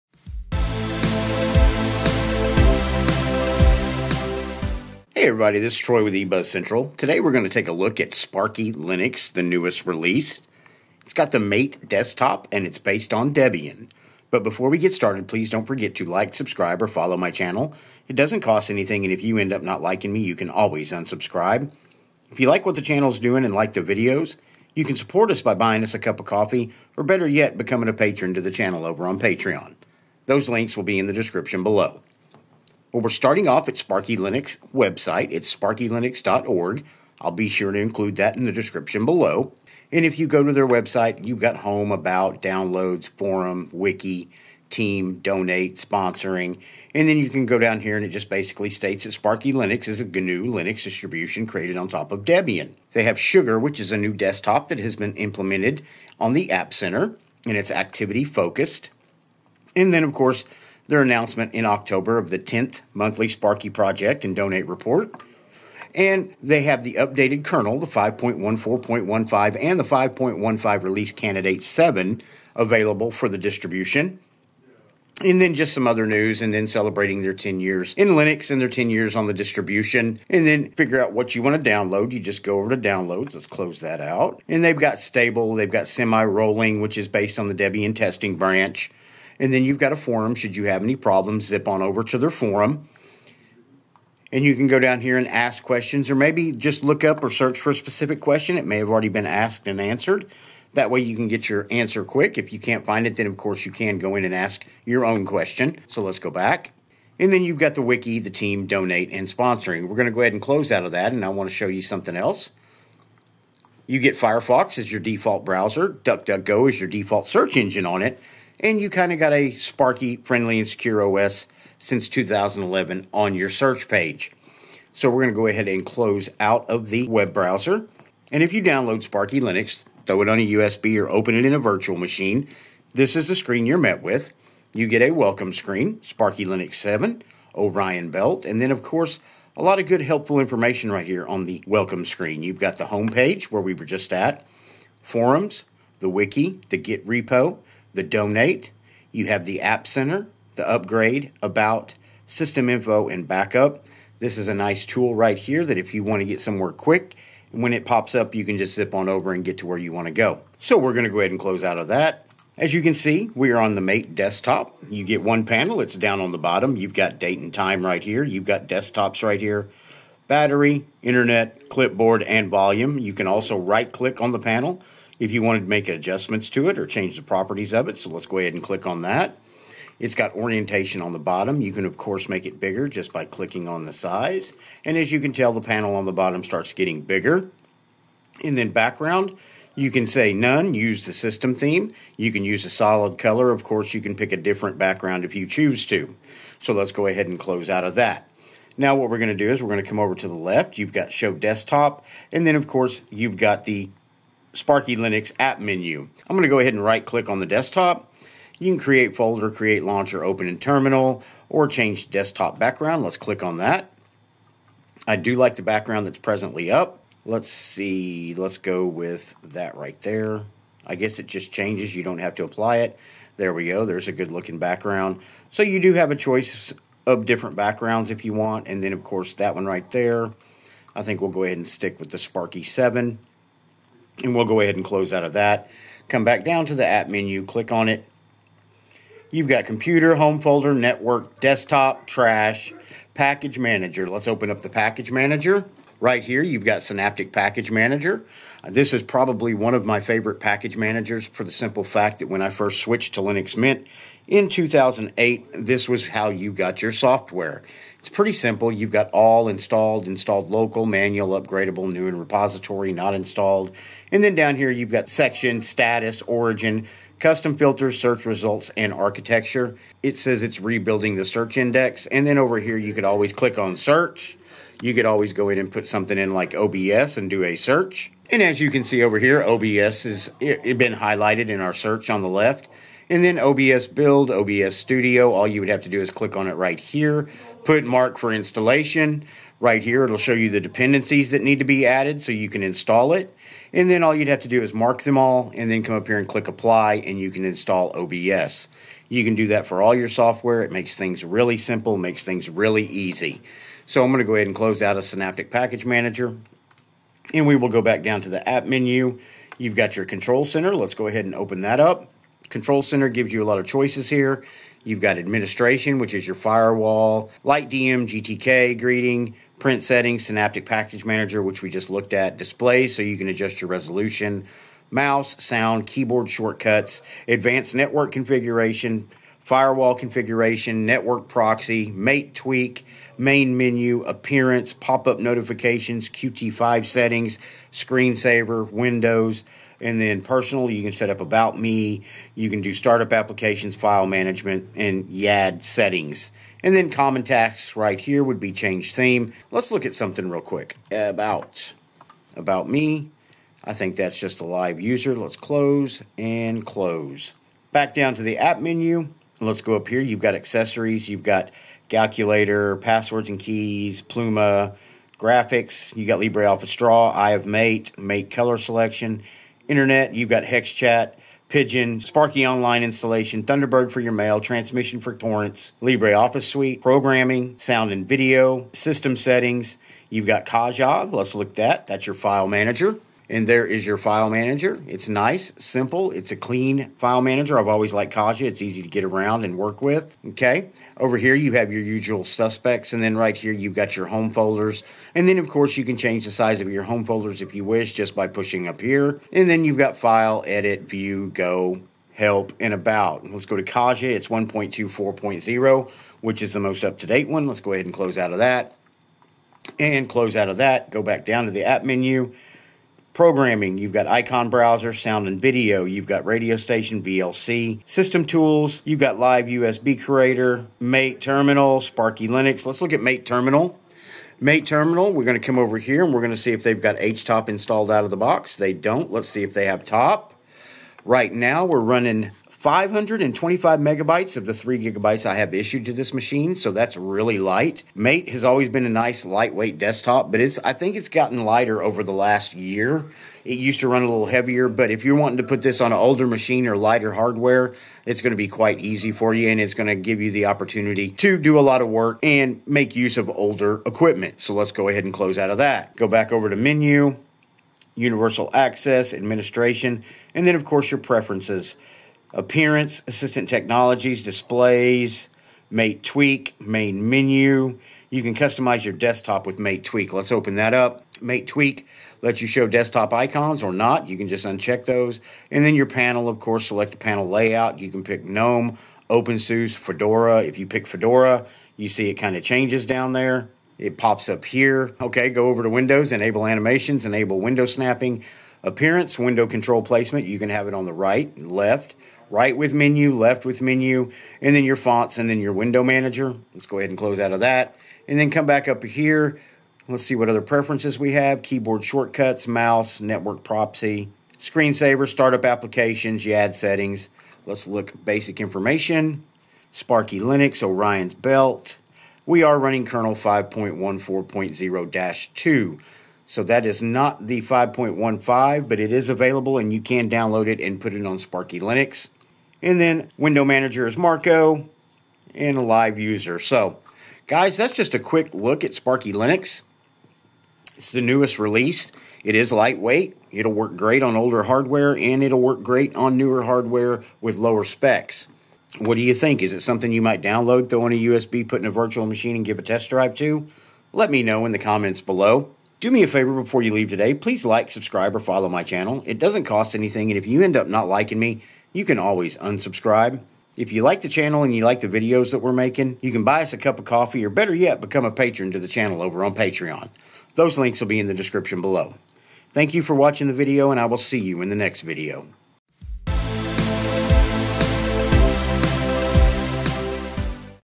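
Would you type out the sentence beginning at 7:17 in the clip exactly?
Mate has always been a nice lightweight desktop, but it's I think it's gotten lighter over the last year.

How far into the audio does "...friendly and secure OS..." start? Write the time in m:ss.
2:00.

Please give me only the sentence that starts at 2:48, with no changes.
You've got desktops right here, battery, internet, clipboard, and volume.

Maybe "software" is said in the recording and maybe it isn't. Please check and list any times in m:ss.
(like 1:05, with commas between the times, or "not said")
4:16, 5:00.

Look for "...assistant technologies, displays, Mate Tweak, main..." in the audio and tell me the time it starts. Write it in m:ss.
7:43.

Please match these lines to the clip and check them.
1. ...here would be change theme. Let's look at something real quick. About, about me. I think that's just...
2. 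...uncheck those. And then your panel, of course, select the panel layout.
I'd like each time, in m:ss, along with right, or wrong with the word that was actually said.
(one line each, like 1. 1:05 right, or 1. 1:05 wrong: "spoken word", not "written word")
1. 5:47 right
2. 7:54 right.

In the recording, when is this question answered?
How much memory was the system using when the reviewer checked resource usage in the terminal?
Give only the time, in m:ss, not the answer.
7:12.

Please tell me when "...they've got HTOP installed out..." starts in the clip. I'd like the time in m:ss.
7:06.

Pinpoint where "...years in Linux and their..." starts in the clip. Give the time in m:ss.
1:17.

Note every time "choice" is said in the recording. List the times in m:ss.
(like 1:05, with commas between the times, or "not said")
3:46, 5:13.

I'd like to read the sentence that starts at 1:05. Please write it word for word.
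And they have the updated kernel, the 5.14.15 and the 5.15 release candidate 7 available for the distribution.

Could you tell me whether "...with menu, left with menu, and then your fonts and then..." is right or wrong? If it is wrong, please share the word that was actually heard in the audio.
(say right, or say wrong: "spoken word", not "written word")
right.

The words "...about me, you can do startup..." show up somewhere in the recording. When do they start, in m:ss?
5:41.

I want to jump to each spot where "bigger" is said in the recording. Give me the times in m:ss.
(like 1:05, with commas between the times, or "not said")
3:02, 3:07.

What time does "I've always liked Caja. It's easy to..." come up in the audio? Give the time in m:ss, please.
6:27.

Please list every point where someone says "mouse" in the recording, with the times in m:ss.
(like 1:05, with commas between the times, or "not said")
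5:24, 8:22.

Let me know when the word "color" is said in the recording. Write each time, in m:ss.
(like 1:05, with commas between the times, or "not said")
3:13, 6:08.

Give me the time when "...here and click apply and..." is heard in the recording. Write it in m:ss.
4:56.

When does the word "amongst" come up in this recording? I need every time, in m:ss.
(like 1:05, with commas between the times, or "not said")
not said.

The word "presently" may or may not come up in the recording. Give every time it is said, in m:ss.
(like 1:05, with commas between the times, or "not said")
3:36.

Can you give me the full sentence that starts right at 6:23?
And there is your file manager.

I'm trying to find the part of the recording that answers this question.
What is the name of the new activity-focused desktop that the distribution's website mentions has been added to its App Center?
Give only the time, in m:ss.
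0:53.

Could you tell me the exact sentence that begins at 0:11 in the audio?
It's got the Mate desktop and it's based on Debian.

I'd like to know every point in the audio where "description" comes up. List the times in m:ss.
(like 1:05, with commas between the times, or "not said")
0:31, 0:38, 9:21.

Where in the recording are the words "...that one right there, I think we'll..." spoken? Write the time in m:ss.
3:49.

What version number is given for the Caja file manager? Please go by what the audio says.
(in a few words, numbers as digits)
1.24.0.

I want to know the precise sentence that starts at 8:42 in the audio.
And then window manager is Marco and a live user.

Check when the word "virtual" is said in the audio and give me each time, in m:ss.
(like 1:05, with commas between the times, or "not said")
2:11, 9:01.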